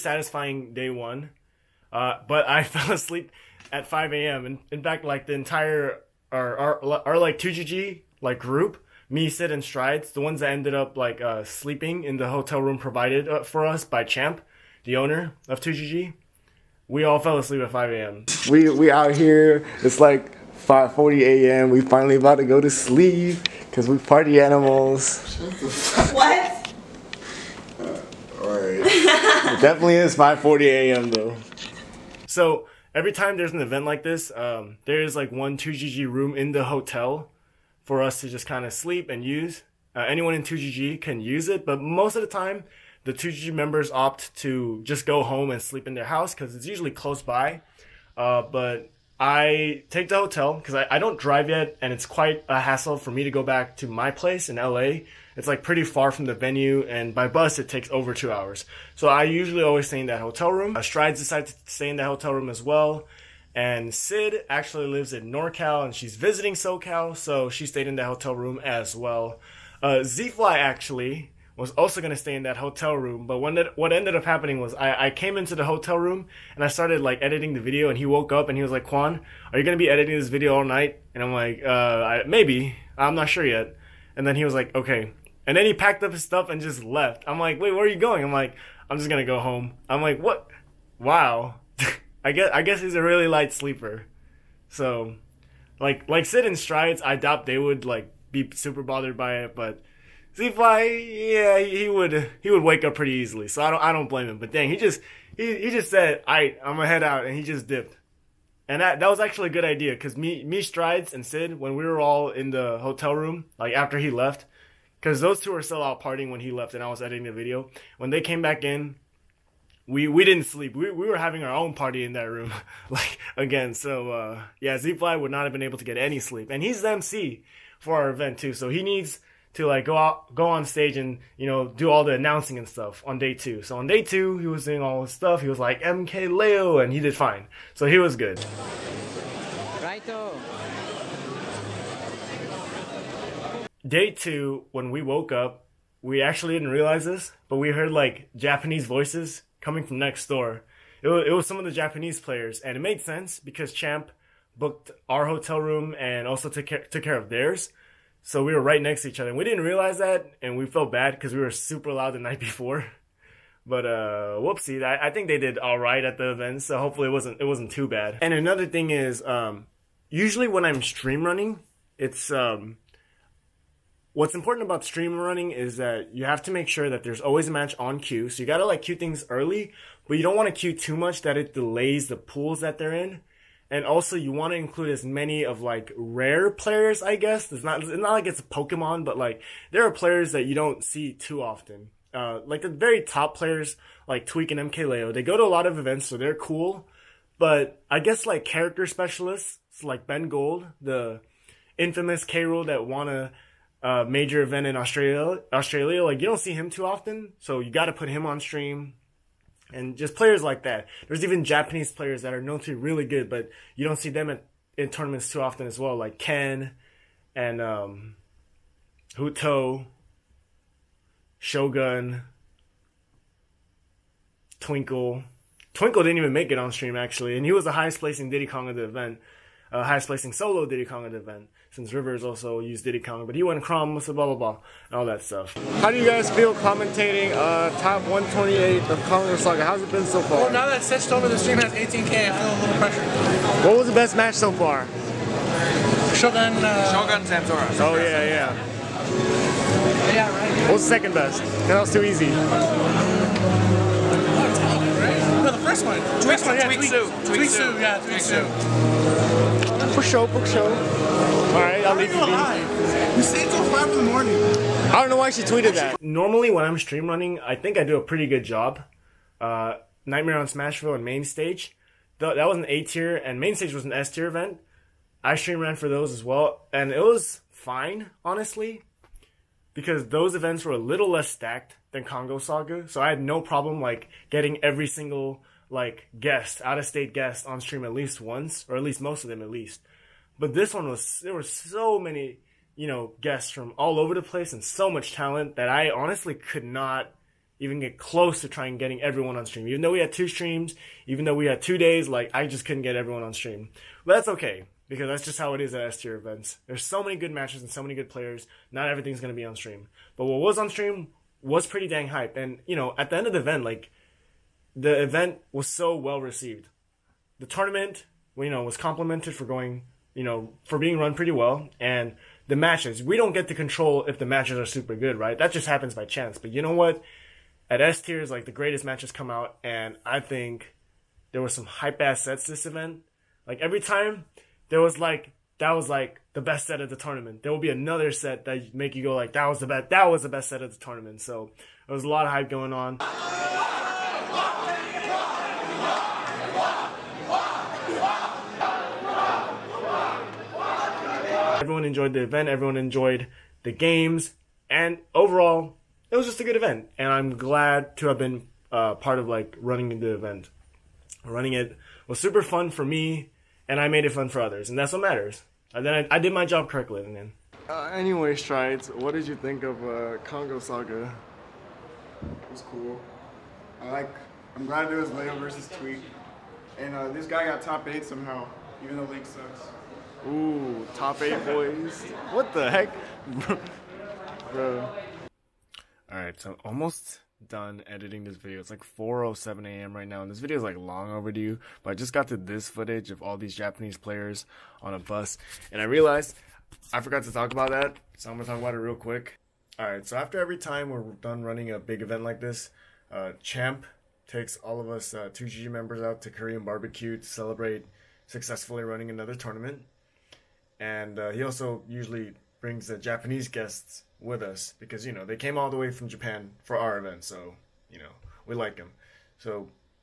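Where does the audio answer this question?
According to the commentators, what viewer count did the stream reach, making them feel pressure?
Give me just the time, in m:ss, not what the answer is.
4:01.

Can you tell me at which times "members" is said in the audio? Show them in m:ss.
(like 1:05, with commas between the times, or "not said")
0:43, 6:45.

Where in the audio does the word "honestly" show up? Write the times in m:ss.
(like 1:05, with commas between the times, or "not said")
4:38, 4:55.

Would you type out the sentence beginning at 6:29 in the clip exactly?
right now, and this video is like long overdue.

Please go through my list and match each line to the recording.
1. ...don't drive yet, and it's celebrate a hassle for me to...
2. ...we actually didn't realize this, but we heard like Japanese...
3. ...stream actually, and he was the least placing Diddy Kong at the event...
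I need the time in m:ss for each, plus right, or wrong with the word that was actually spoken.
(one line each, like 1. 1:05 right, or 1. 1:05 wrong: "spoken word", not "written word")
1. 0:50 wrong: "quite", not "celebrate"
2. 2:26 right
3. 3:46 wrong: "highest", not "least".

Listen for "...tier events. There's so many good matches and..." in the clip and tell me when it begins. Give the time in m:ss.
5:06.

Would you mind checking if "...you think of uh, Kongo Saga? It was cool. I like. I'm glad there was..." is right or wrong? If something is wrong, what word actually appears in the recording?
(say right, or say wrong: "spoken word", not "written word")
right.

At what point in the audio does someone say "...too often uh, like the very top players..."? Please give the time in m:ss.
3:11.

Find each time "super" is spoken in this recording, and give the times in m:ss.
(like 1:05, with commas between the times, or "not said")
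1:38, 2:41, 5:24, 6:02.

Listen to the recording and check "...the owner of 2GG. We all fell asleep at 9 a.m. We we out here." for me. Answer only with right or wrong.
wrong.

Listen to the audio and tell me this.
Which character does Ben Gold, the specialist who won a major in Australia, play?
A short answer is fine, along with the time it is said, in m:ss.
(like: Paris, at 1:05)
K. Rool, at 3:22.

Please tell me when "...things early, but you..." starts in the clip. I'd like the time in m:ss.
2:58.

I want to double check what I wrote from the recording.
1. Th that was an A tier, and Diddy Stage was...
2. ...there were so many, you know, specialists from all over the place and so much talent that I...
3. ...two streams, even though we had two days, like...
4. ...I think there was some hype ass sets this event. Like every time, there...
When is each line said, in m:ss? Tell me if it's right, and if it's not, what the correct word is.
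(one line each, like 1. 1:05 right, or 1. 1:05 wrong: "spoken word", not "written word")
1. 4:32 wrong: "Main", not "Diddy"
2. 4:51 wrong: "guests", not "specialists"
3. 5:00 right
4. 5:30 right.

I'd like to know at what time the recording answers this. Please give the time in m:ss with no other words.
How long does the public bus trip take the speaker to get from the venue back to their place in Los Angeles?
0:57.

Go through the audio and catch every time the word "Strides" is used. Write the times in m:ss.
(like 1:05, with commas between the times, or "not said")
0:09, 1:00, 1:36, 1:50, 6:08.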